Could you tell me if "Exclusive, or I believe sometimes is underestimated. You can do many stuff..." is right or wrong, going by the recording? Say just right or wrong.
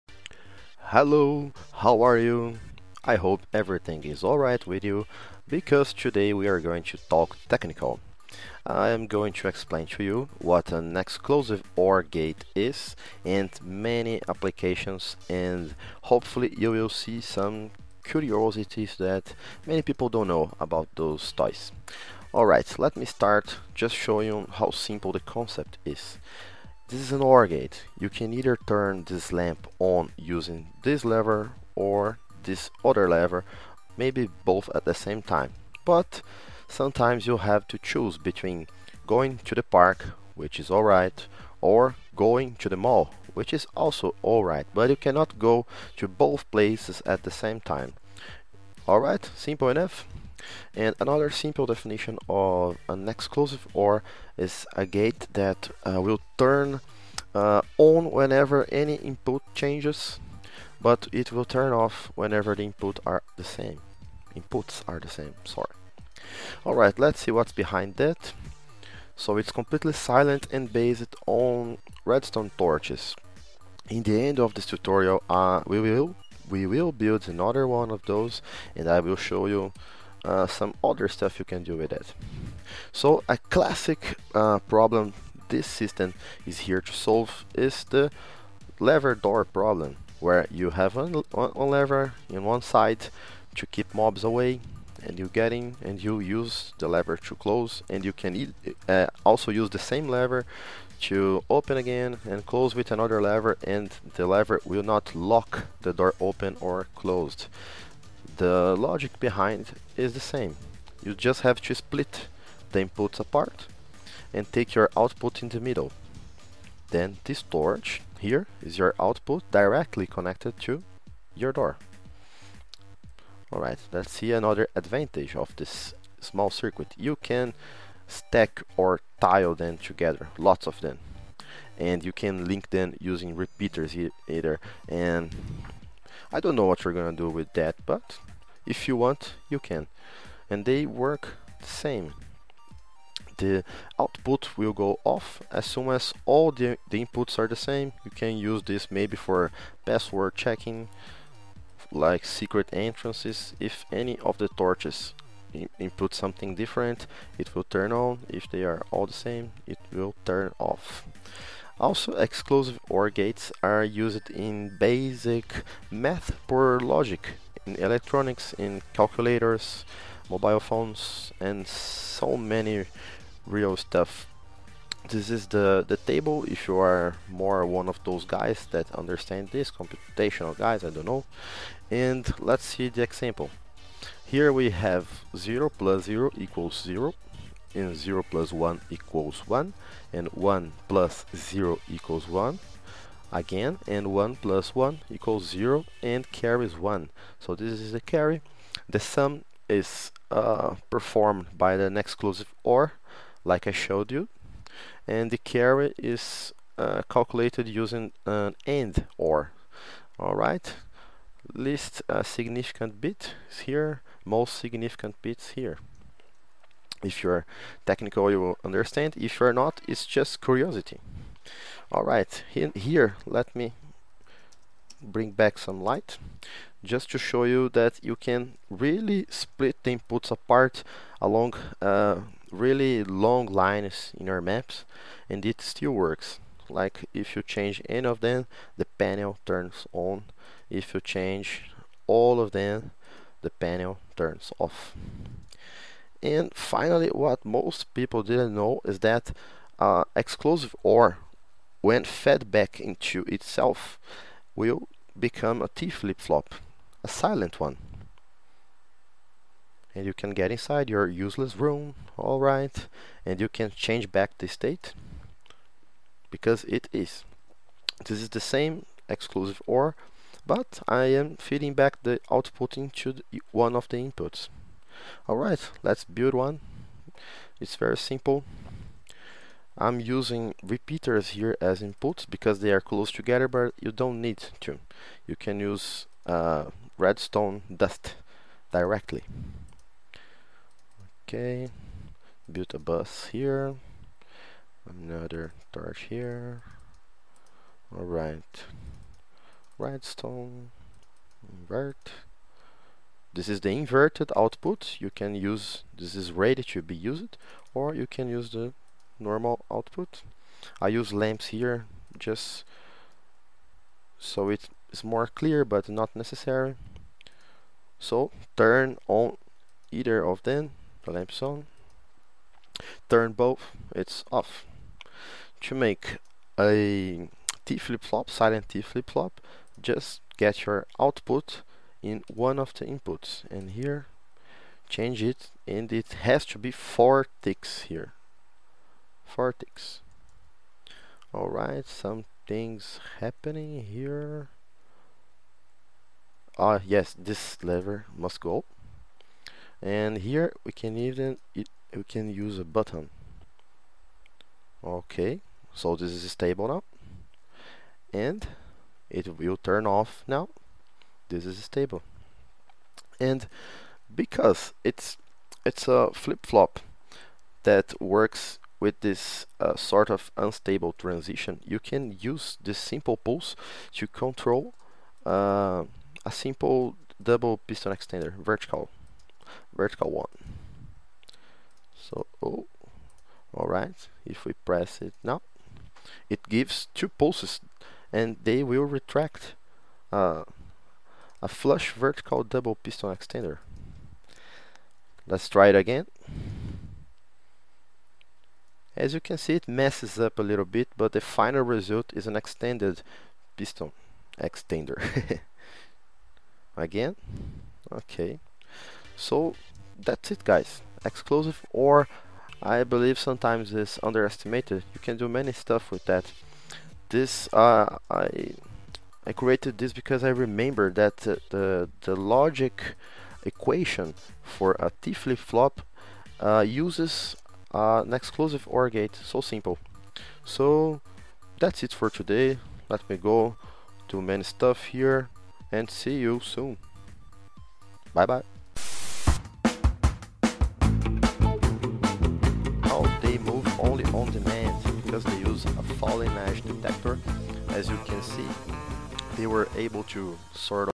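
right.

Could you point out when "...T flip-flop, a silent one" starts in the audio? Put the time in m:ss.
4:15.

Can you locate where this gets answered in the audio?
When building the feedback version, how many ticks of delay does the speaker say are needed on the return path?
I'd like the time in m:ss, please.
5:36.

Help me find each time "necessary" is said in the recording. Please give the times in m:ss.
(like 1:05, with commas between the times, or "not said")
5:16.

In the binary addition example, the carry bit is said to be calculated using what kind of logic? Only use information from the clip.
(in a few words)
AND OR.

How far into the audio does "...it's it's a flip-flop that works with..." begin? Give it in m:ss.
6:04.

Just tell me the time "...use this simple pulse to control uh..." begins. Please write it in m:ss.
6:12.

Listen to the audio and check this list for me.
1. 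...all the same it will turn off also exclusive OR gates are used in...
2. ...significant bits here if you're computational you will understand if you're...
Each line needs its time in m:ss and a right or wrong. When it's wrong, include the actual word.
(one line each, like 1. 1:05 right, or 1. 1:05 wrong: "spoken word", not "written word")
1. 2:38 right
2. 3:34 wrong: "technical", not "computational".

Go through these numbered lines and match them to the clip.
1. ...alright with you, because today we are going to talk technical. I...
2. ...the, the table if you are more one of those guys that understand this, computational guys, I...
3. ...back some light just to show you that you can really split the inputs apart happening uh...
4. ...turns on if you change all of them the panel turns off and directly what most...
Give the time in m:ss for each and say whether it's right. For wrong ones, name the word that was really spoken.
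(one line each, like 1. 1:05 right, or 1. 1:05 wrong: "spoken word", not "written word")
1. 0:04 right
2. 2:55 right
3. 3:45 wrong: "along", not "happening"
4. 3:59 wrong: "finally", not "directly".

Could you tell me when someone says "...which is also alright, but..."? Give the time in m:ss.
0:43.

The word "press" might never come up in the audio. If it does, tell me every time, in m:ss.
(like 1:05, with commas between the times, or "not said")
6:24.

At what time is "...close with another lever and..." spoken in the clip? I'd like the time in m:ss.
1:42.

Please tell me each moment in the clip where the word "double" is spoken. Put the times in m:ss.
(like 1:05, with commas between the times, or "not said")
6:17, 6:32.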